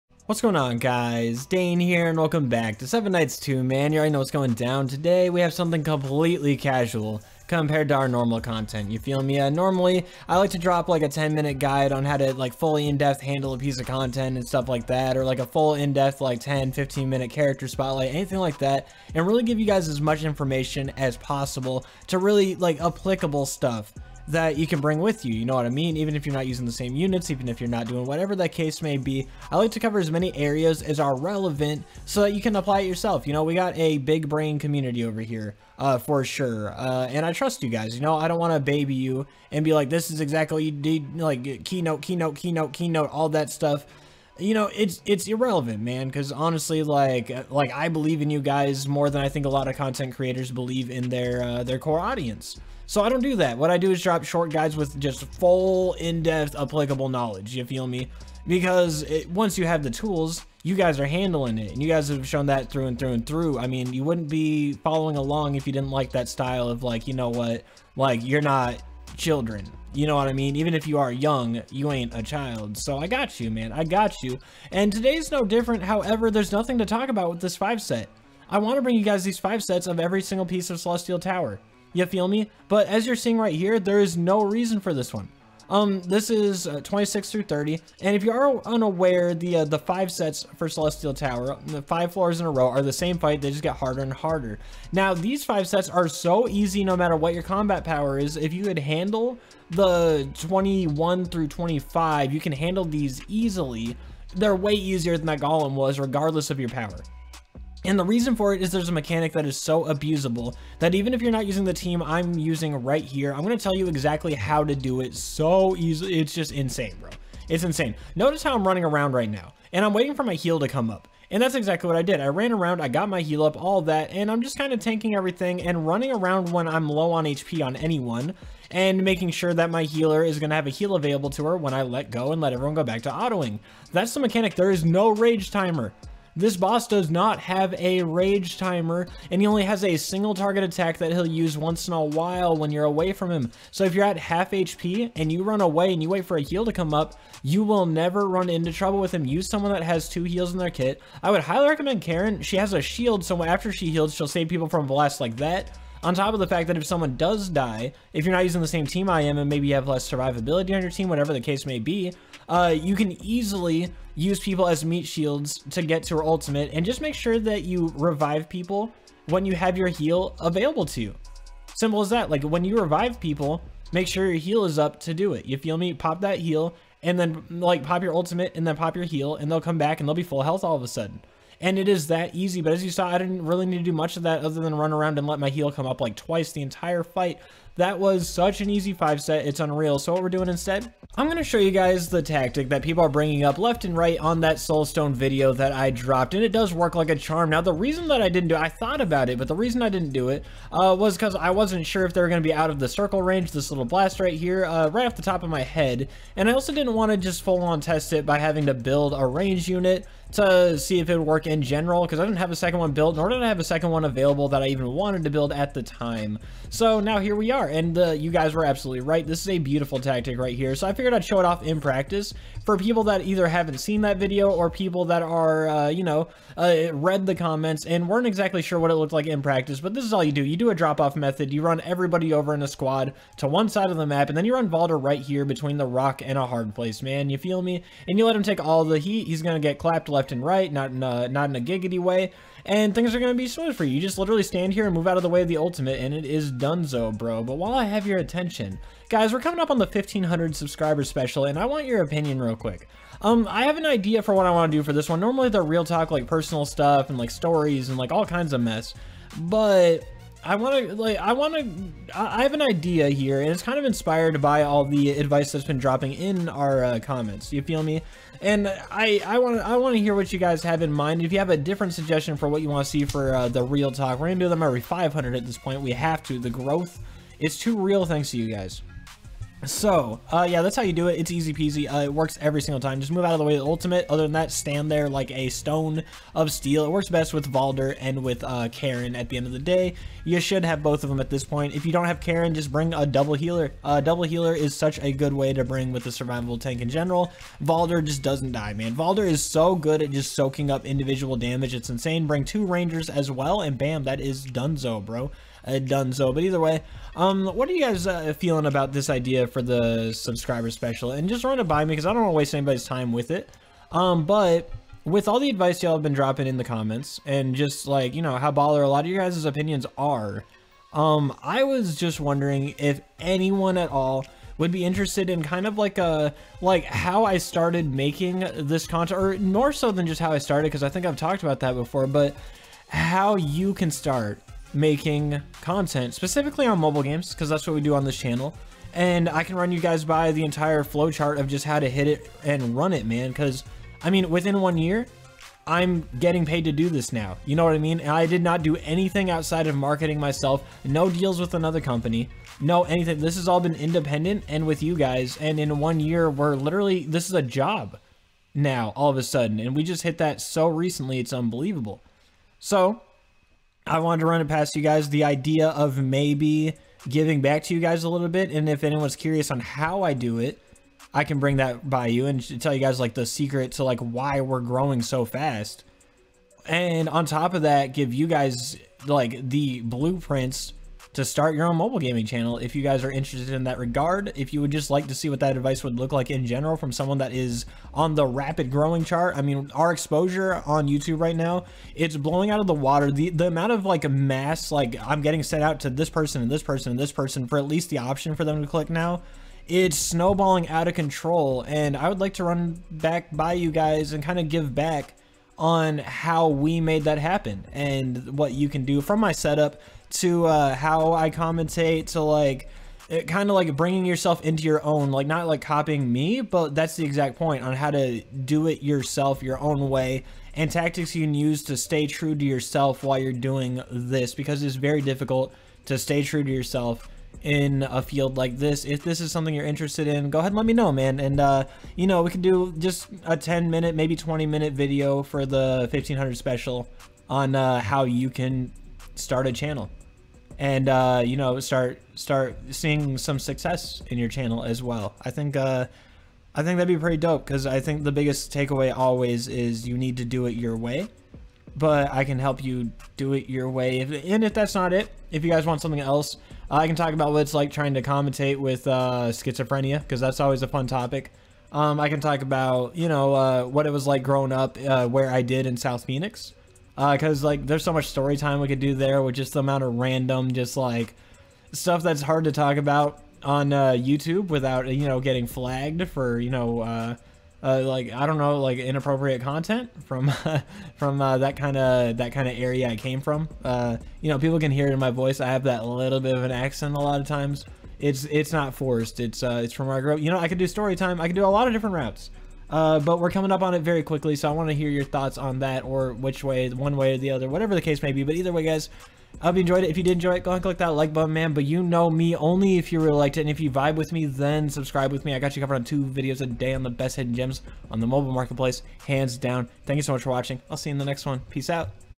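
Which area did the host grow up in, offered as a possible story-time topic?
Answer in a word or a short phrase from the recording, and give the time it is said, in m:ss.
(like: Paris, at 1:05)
South Phoenix, at 7:45.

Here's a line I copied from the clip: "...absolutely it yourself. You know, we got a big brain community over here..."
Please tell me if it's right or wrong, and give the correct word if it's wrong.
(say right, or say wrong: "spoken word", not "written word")
wrong: "apply", not "absolutely".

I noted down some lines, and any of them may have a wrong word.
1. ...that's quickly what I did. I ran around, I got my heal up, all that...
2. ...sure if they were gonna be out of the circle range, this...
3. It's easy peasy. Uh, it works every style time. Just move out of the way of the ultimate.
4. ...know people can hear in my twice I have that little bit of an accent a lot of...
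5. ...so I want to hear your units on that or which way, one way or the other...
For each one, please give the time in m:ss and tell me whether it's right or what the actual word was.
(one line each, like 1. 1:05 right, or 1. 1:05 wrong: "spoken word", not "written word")
1. 2:01 wrong: "exactly", not "quickly"
2. 3:21 right
3. 4:41 wrong: "single", not "style"
4. 8:04 wrong: "voice", not "twice"
5. 8:14 wrong: "thoughts", not "units".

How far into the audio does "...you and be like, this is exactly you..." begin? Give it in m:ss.
0:38.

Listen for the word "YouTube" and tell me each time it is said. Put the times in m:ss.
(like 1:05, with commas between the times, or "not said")
6:30, 7:53.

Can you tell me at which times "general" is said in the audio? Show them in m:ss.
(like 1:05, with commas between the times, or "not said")
3:31, 4:56, 6:26.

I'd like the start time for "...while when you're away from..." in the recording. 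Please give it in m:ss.
2:22.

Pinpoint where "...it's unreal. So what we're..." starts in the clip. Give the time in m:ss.
3:09.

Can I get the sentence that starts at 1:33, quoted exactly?
They just get harder and harder.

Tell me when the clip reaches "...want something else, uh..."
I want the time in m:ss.
7:35.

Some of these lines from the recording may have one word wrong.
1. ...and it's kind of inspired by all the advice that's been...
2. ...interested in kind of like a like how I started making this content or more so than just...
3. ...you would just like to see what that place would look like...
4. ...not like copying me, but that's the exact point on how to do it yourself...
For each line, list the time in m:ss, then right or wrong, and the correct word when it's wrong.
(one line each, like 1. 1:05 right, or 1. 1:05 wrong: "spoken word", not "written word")
1. 4:23 right
2. 5:24 right
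3. 6:24 wrong: "advice", not "place"
4. 6:55 right.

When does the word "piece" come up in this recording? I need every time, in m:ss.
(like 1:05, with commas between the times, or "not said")
0:13, 1:20.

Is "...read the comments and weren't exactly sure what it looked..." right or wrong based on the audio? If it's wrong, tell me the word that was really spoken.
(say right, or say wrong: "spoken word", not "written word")
right.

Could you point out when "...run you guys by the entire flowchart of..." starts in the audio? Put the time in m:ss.
5:39.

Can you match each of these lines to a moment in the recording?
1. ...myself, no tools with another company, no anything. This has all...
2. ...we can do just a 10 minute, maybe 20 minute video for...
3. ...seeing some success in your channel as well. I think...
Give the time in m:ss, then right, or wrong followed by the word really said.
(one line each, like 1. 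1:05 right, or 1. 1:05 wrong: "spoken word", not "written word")
1. 5:50 wrong: "deals", not "tools"
2. 7:12 right
3. 7:22 right.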